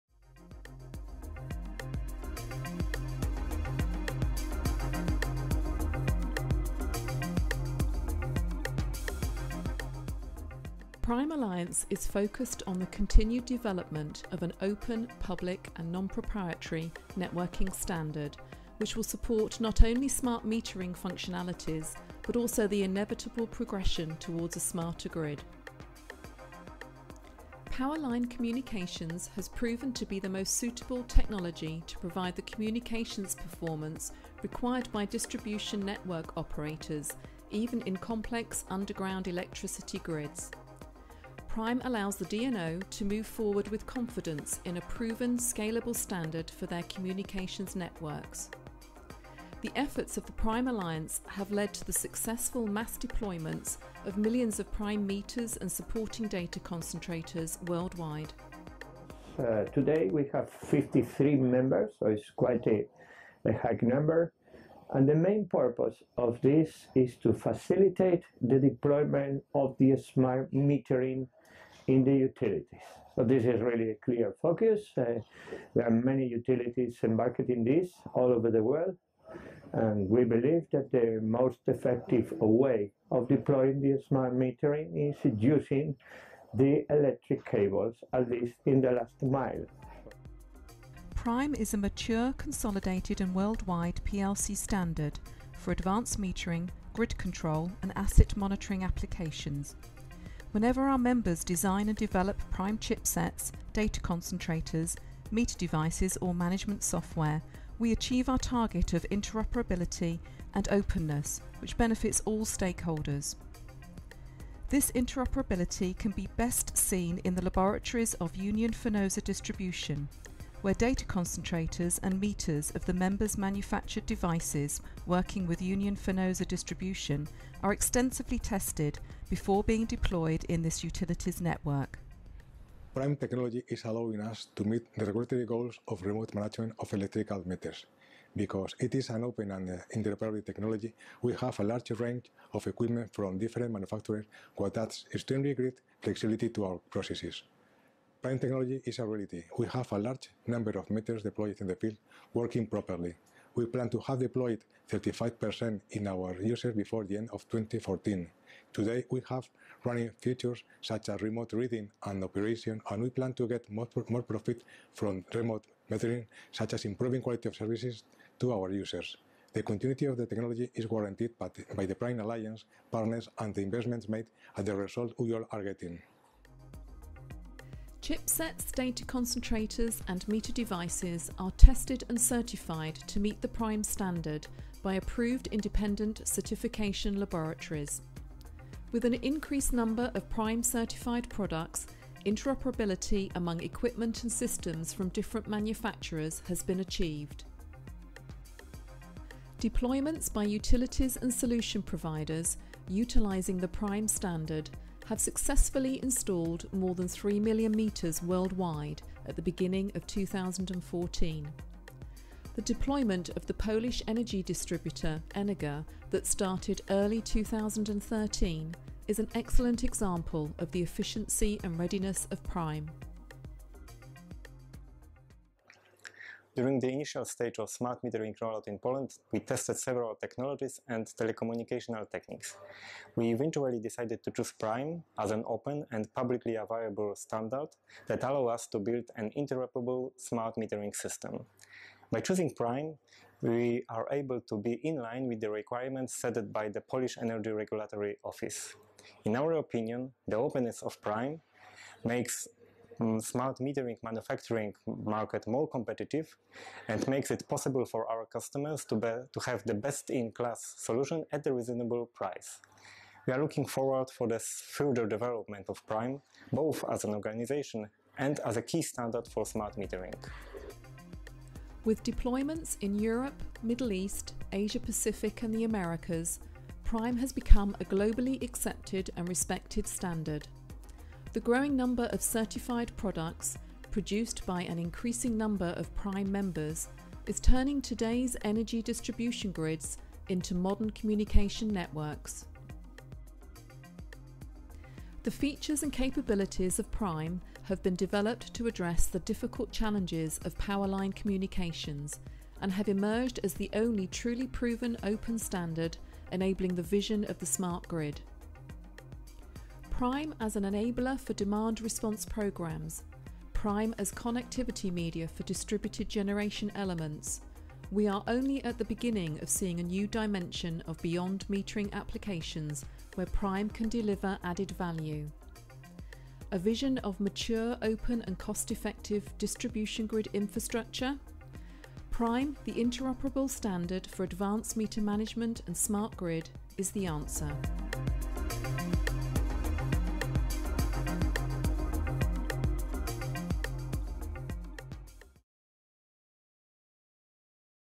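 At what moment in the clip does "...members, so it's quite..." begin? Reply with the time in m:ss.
1:01.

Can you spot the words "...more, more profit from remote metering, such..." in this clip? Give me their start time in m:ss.
2:43.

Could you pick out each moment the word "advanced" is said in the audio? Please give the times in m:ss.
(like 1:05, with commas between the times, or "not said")
1:35, 5:34.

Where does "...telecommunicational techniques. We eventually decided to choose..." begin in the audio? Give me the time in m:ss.
3:51.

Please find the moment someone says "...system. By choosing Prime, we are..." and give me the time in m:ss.
4:00.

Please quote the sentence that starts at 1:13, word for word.
So this is really a clear focus.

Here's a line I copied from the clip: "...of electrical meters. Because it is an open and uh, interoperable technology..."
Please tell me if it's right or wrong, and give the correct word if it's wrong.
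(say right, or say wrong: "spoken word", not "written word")
right.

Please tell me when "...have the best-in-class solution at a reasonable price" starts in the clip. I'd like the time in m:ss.
4:19.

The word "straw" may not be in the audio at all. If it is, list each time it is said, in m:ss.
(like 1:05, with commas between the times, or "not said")
not said.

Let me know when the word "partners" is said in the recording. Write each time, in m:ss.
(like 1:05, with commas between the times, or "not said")
2:52.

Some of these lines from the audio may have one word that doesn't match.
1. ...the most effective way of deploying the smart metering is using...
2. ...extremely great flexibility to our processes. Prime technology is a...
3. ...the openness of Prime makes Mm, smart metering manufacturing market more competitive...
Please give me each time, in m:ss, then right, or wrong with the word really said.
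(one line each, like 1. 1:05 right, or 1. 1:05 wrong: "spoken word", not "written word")
1. 1:20 right
2. 2:25 right
3. 4:10 right.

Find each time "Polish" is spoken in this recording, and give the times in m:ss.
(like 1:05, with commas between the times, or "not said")
3:33, 4:06.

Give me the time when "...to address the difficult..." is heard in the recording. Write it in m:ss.
4:58.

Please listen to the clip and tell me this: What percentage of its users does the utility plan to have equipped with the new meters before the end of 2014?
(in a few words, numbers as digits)
35%.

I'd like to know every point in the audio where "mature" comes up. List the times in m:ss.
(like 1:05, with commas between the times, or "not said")
1:31, 5:27.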